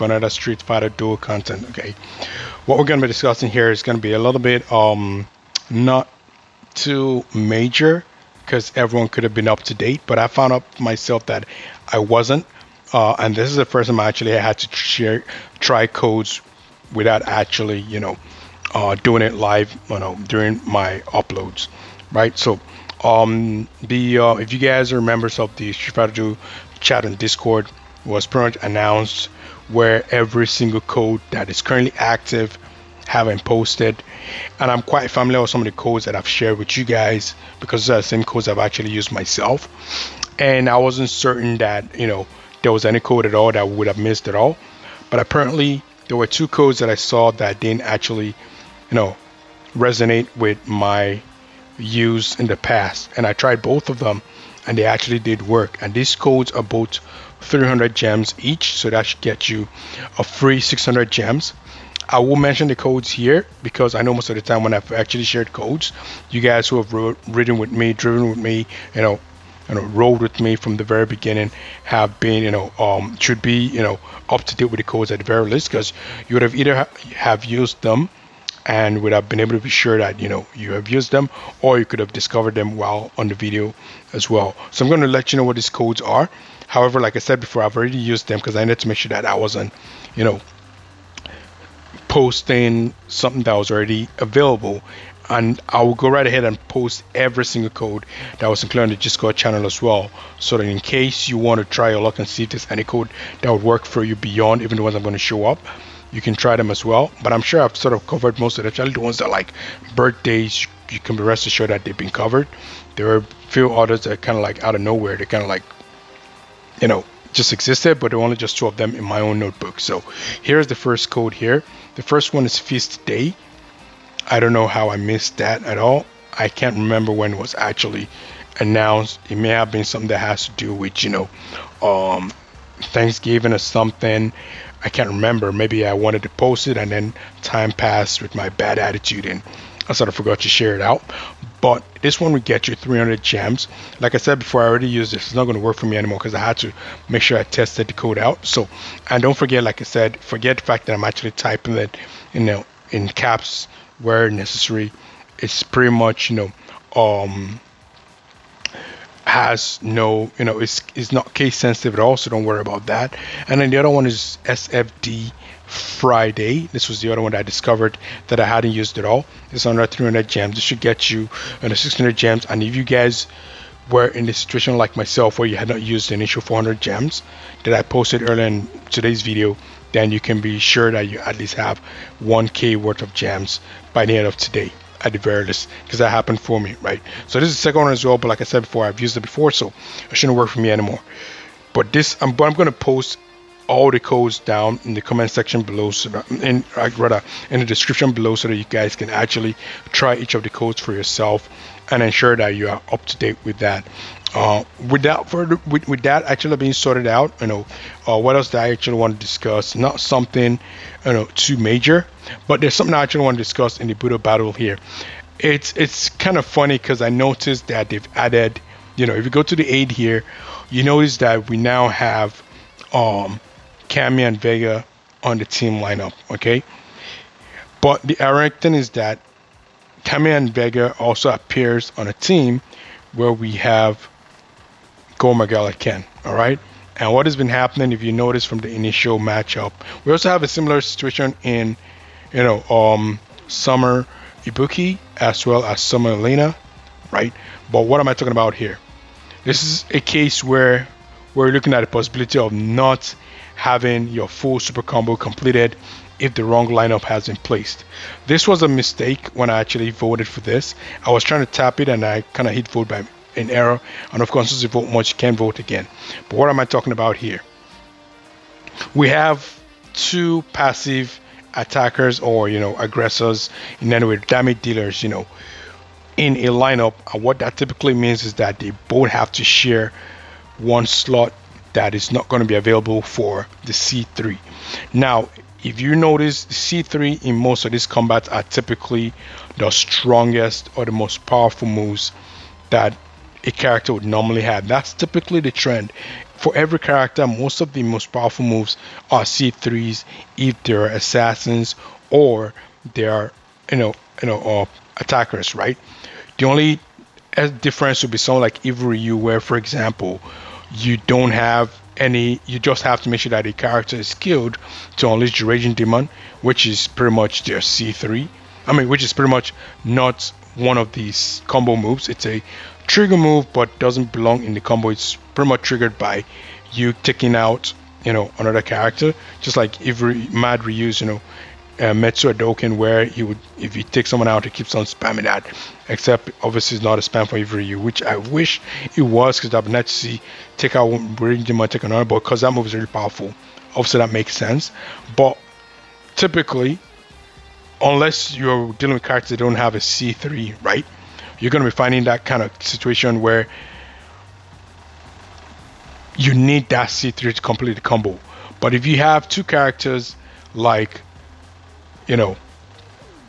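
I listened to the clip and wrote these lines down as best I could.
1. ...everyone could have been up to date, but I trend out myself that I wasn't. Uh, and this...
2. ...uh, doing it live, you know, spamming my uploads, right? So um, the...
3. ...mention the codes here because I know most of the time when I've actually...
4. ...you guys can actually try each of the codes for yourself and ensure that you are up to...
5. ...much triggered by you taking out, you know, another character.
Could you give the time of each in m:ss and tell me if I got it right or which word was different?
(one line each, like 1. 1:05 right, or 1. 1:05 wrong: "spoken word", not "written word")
1. 0:08 wrong: "found", not "trend"
2. 0:18 wrong: "during", not "spamming"
3. 1:02 right
4. 3:18 right
5. 5:25 right.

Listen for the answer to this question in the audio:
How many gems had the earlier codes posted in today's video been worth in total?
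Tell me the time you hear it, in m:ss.
2:56.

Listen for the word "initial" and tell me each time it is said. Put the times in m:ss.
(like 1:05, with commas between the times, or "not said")
2:56, 3:58.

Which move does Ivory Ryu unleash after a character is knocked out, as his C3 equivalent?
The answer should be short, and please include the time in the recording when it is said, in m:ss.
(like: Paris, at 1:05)
Raging Demon, at 5:15.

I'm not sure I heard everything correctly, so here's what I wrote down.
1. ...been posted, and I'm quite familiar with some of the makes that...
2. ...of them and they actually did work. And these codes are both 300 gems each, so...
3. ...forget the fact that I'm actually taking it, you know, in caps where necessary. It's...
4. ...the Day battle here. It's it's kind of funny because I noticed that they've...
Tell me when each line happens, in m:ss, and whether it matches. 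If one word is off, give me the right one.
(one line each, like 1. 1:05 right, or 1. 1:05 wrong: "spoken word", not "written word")
1. 0:33 wrong: "codes", not "makes"
2. 0:53 right
3. 2:30 wrong: "typing", not "taking"
4. 3:33 wrong: "Budo", not "Day".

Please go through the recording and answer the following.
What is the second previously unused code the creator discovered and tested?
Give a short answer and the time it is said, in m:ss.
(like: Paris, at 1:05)
SFD Friday, at 2:44.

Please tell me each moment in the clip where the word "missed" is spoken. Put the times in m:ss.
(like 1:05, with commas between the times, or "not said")
0:43, 2:04.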